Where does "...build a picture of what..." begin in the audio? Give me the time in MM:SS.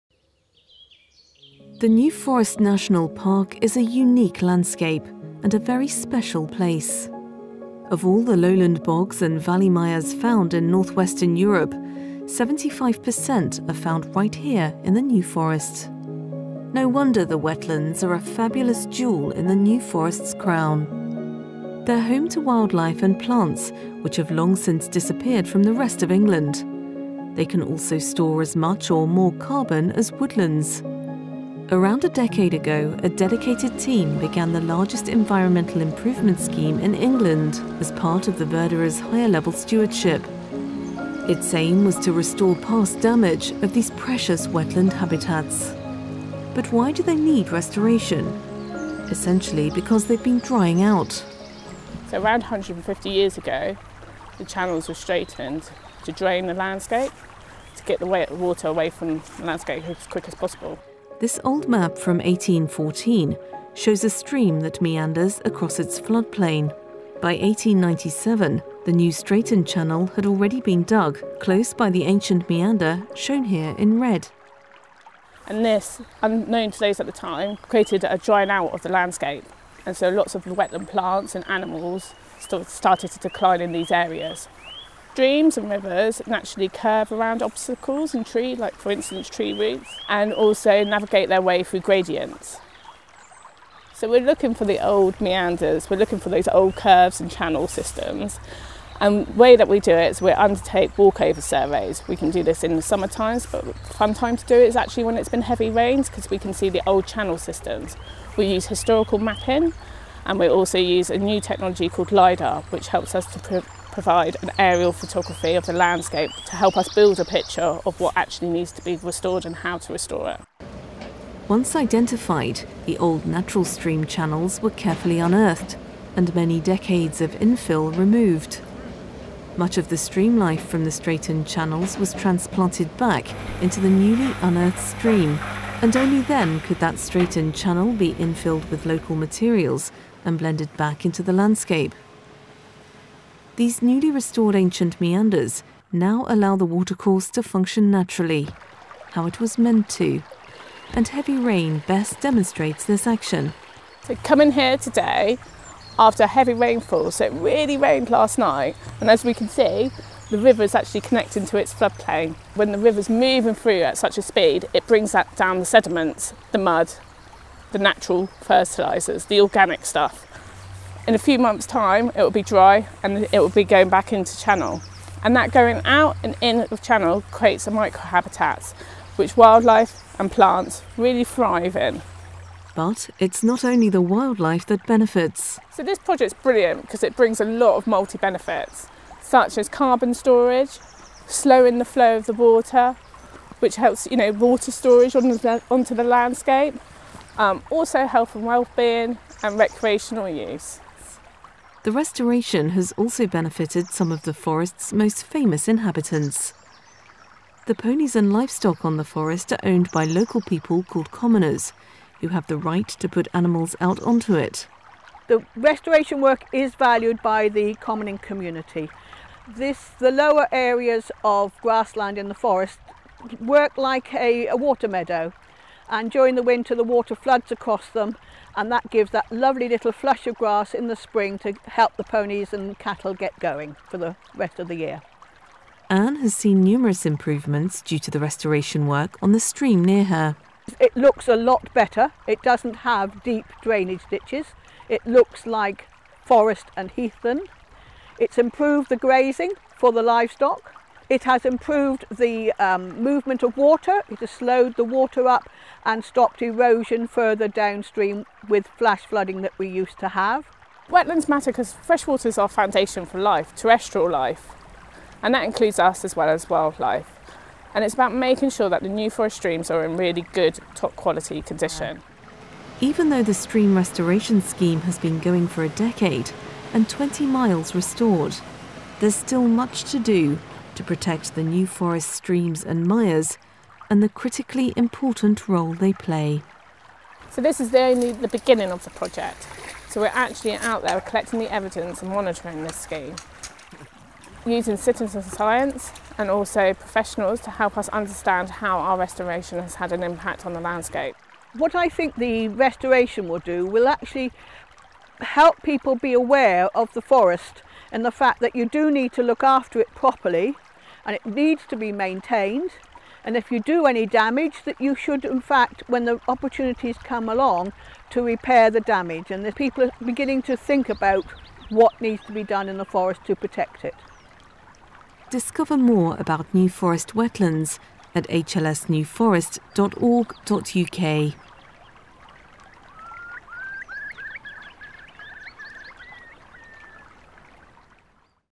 01:56.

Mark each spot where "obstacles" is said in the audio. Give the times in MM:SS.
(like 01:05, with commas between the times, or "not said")
01:27.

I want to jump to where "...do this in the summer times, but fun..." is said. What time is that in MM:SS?
01:42.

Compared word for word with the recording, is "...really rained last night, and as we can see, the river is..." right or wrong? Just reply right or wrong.
right.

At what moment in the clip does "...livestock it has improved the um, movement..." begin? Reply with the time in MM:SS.
04:10.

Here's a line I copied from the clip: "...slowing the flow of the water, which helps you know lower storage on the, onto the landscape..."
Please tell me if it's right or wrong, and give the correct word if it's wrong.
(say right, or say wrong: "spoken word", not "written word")
wrong: "water", not "lower".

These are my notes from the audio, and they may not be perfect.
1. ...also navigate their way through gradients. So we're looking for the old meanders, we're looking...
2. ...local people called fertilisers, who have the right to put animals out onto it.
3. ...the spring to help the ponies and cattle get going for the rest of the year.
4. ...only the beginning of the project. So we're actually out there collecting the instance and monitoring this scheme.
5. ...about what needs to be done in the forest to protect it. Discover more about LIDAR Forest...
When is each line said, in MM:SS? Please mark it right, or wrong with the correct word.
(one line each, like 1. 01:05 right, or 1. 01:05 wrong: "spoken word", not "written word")
1. 01:30 right
2. 03:30 wrong: "commoners", not "fertilisers"
3. 03:50 right
4. 04:47 wrong: "evidence", not "instance"
5. 05:20 wrong: "New", not "LIDAR".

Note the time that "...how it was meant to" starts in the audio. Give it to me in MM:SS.
02:29.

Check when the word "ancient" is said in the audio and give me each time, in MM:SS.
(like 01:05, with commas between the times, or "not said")
01:12, 02:24.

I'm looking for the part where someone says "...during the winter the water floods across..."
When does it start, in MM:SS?
03:46.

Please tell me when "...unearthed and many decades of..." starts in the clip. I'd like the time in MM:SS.
02:05.